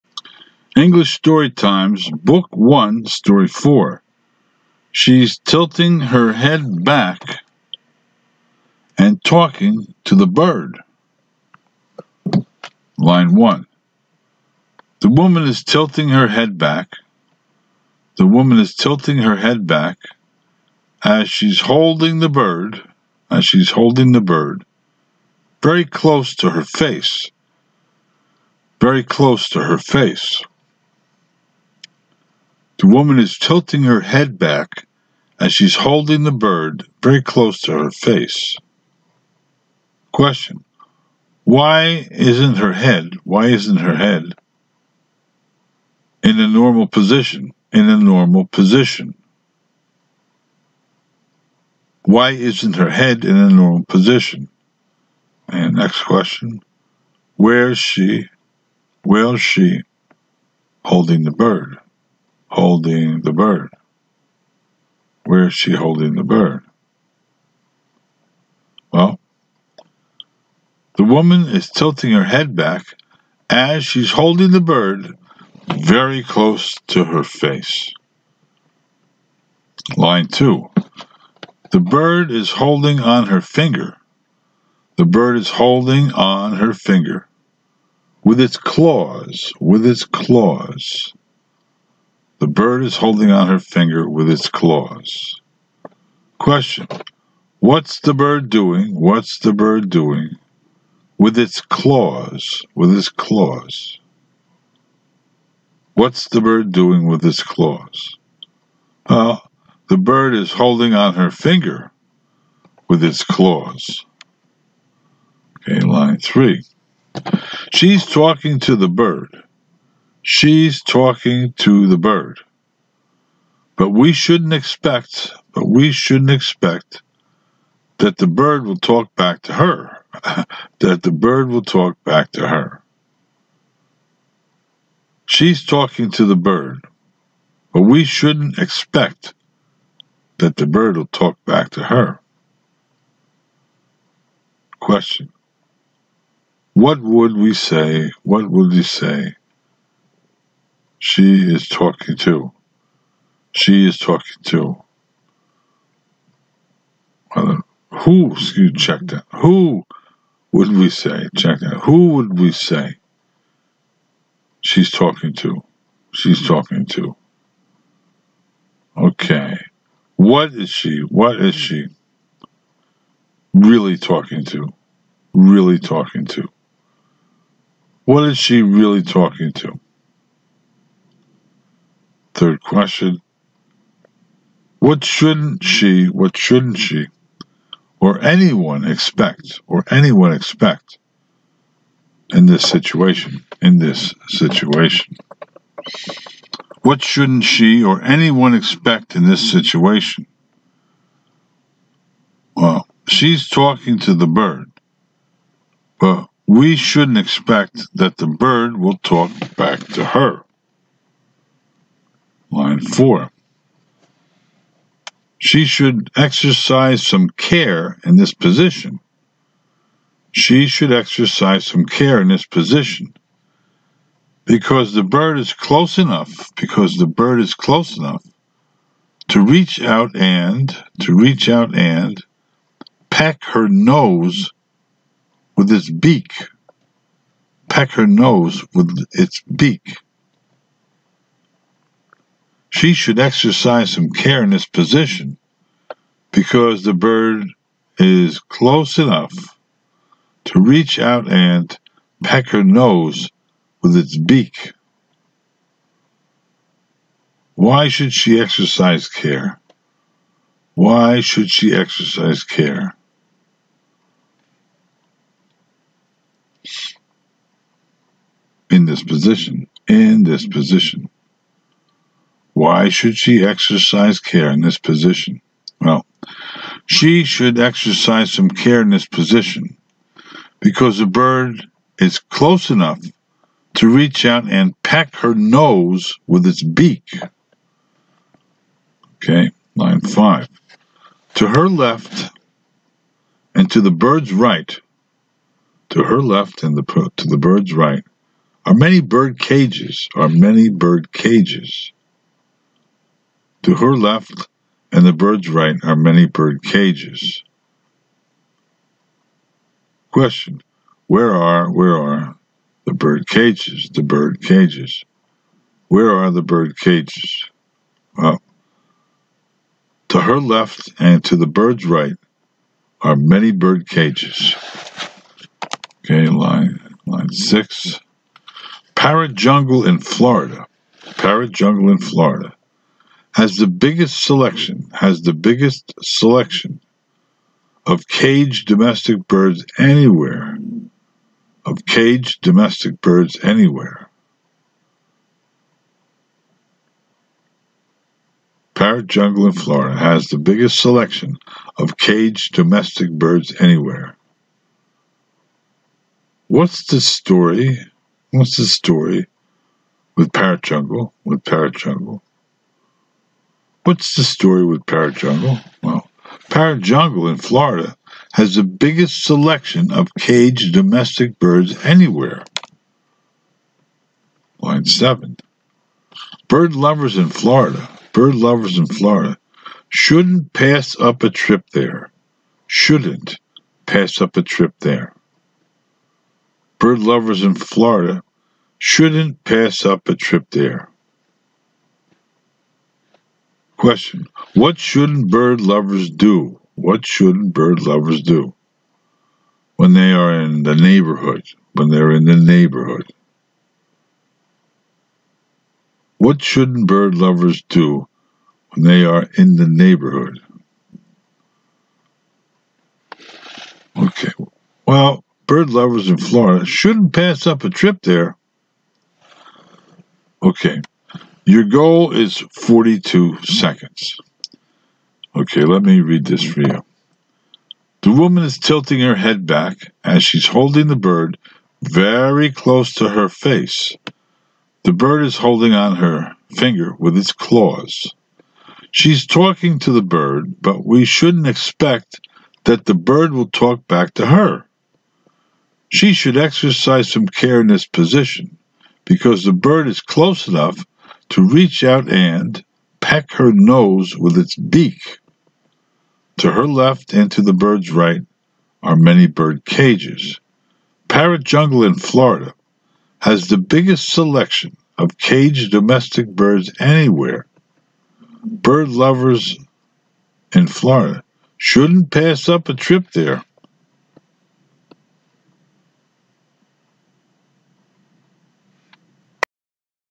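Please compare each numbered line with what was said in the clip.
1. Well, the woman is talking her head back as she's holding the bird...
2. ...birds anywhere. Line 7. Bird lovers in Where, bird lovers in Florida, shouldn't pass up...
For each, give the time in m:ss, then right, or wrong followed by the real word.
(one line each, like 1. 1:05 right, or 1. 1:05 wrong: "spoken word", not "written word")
1. 1:08 wrong: "tilting", not "talking"
2. 6:11 wrong: "Florida", not "Where".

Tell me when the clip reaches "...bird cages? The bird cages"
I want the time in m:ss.
5:12.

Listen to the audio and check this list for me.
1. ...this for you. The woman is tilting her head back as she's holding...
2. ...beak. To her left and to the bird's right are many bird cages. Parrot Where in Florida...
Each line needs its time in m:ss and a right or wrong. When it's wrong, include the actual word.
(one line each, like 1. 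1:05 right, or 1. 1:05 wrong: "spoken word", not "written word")
1. 7:06 right
2. 7:34 wrong: "Jungle", not "Where".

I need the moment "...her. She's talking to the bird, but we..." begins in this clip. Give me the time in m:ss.
2:12.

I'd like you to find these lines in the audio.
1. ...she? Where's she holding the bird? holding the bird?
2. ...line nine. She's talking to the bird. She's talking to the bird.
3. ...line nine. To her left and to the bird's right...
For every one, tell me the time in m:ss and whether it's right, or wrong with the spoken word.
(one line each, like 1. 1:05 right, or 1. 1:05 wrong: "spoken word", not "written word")
1. 0:57 right
2. 1:55 wrong: "three", not "nine"
3. 4:49 wrong: "five", not "nine".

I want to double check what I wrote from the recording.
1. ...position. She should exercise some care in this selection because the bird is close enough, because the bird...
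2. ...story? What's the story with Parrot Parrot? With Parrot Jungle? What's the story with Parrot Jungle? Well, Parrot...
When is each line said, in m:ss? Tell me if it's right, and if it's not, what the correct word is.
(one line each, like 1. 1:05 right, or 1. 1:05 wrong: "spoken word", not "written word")
1. 3:38 wrong: "position", not "selection"
2. 5:56 wrong: "Jungle", not "Parrot".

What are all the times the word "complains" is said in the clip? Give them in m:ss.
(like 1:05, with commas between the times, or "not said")
not said.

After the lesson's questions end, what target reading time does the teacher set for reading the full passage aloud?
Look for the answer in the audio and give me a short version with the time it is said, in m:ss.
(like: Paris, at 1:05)
42 seconds, at 7:02.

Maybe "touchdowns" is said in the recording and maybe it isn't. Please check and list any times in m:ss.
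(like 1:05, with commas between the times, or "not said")
not said.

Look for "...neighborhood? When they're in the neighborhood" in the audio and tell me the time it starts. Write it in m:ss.
6:40.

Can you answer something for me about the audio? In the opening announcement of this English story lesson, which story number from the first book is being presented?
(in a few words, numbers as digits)
4.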